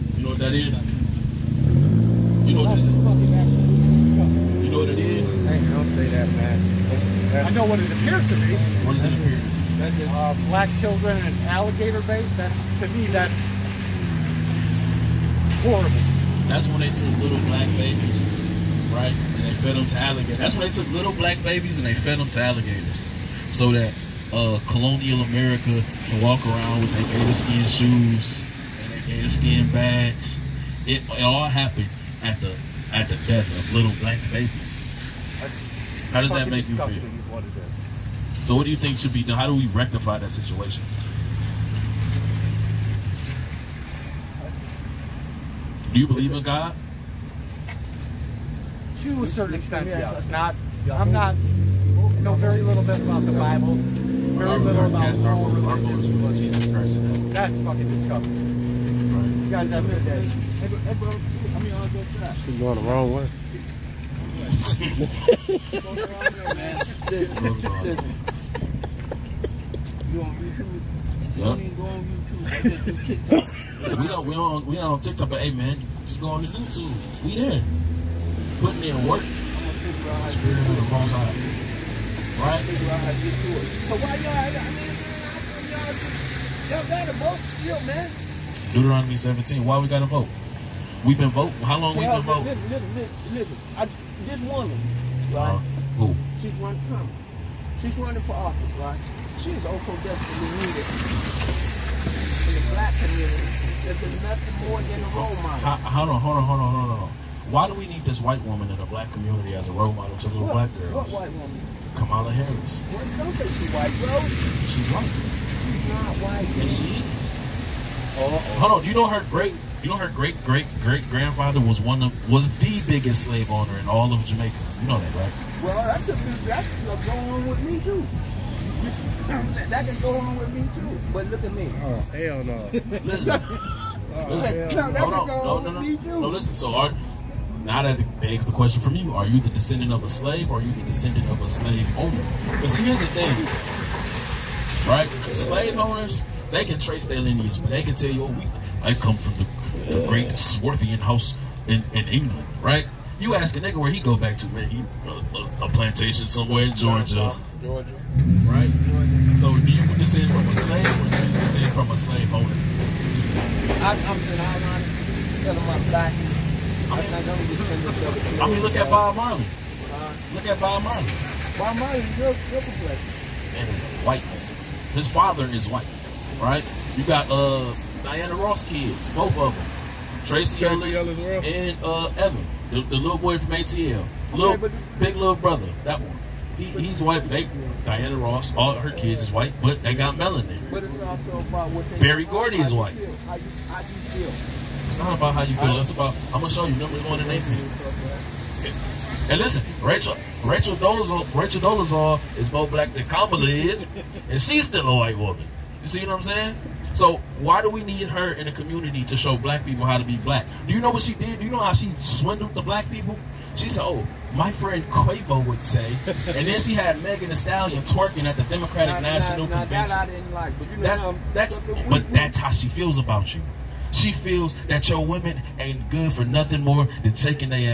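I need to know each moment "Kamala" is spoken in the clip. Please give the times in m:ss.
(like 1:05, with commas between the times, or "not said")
1:51, 3:23.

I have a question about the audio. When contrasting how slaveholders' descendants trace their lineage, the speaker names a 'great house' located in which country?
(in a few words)
England.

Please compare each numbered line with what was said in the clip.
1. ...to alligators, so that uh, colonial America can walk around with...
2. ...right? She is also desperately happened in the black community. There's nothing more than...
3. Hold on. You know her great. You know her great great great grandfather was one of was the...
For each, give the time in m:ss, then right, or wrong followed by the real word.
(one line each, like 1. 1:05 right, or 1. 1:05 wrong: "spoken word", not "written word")
1. 0:22 right
2. 1:38 wrong: "needed", not "happened"
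3. 1:58 right.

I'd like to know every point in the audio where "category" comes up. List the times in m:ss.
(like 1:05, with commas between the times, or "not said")
not said.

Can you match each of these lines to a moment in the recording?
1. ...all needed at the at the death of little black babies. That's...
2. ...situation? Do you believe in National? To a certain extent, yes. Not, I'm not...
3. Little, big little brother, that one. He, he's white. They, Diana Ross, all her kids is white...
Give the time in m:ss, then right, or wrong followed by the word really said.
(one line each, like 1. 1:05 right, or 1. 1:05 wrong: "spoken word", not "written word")
1. 0:31 wrong: "happened", not "needed"
2. 0:40 wrong: "God", not "National"
3. 3:04 right.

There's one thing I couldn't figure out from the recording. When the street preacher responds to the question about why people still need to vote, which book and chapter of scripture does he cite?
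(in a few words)
Deuteronomy 17.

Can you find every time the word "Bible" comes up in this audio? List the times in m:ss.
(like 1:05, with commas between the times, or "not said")
0:53.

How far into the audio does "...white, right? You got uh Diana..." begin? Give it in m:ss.
2:55.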